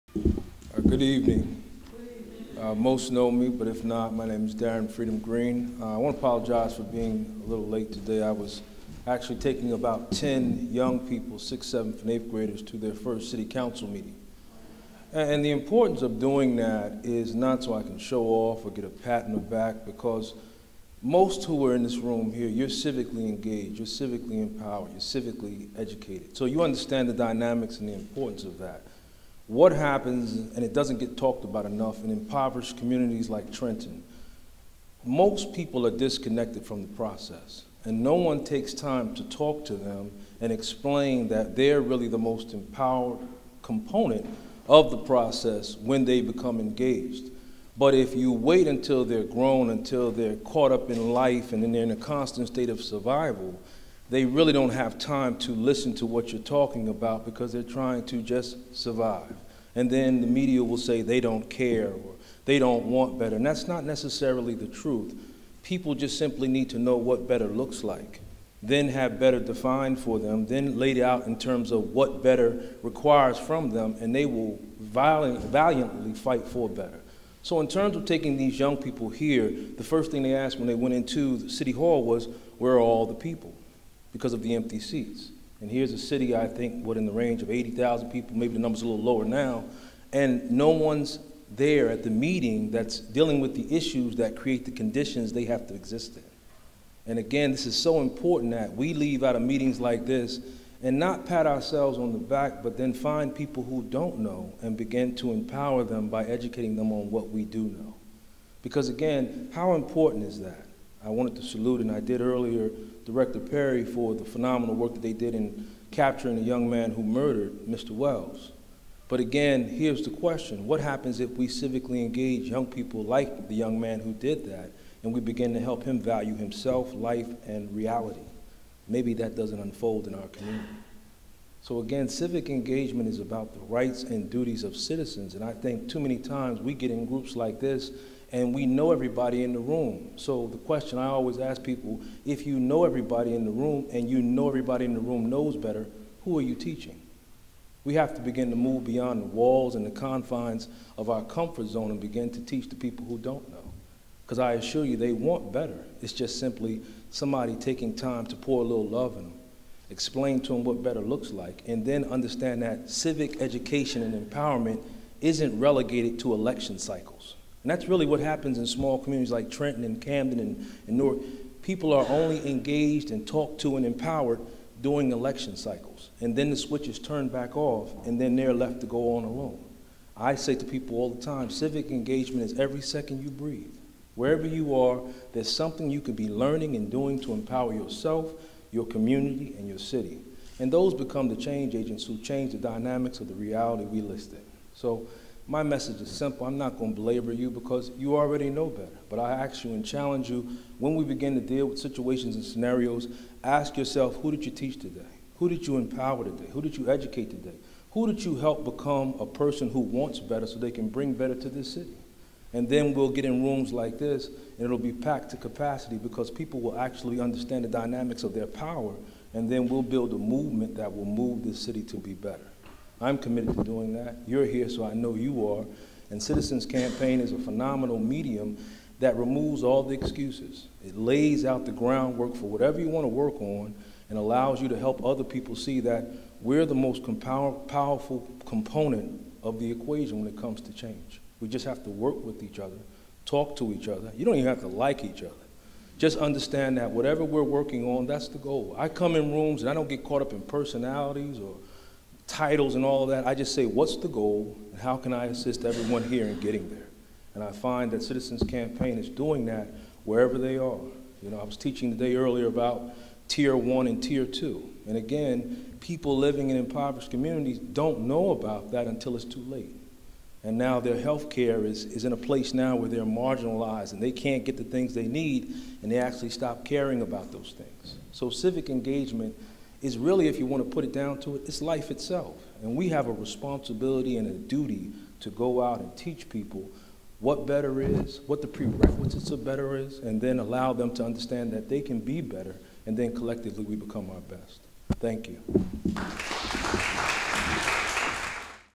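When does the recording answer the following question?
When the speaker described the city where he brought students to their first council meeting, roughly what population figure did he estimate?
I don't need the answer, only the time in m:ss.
1:27.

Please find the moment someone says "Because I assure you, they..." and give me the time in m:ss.
2:34.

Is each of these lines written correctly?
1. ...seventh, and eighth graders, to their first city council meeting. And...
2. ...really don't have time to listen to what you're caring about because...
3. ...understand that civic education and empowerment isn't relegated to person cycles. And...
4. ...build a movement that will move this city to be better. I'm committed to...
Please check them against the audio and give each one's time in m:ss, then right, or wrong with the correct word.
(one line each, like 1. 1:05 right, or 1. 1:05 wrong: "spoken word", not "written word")
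1. 0:11 right
2. 0:54 wrong: "talking", not "caring"
3. 2:42 wrong: "election", not "person"
4. 3:39 right.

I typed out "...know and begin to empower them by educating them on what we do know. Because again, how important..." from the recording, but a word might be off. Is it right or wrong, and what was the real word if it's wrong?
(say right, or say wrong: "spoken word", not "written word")
right.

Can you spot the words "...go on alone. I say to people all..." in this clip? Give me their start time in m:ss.
2:58.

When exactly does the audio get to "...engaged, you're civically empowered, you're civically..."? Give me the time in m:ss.
0:23.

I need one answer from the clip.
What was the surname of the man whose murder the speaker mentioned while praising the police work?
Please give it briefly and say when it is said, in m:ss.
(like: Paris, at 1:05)
Wells, at 1:57.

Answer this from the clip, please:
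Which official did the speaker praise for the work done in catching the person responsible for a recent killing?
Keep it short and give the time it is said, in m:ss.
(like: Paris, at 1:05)
Director Perry, at 1:53.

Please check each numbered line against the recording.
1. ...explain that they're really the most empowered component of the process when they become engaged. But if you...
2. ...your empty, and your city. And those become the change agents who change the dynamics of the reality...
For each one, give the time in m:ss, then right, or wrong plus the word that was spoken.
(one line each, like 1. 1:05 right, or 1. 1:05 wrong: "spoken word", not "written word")
1. 0:40 right
2. 3:08 wrong: "community", not "empty".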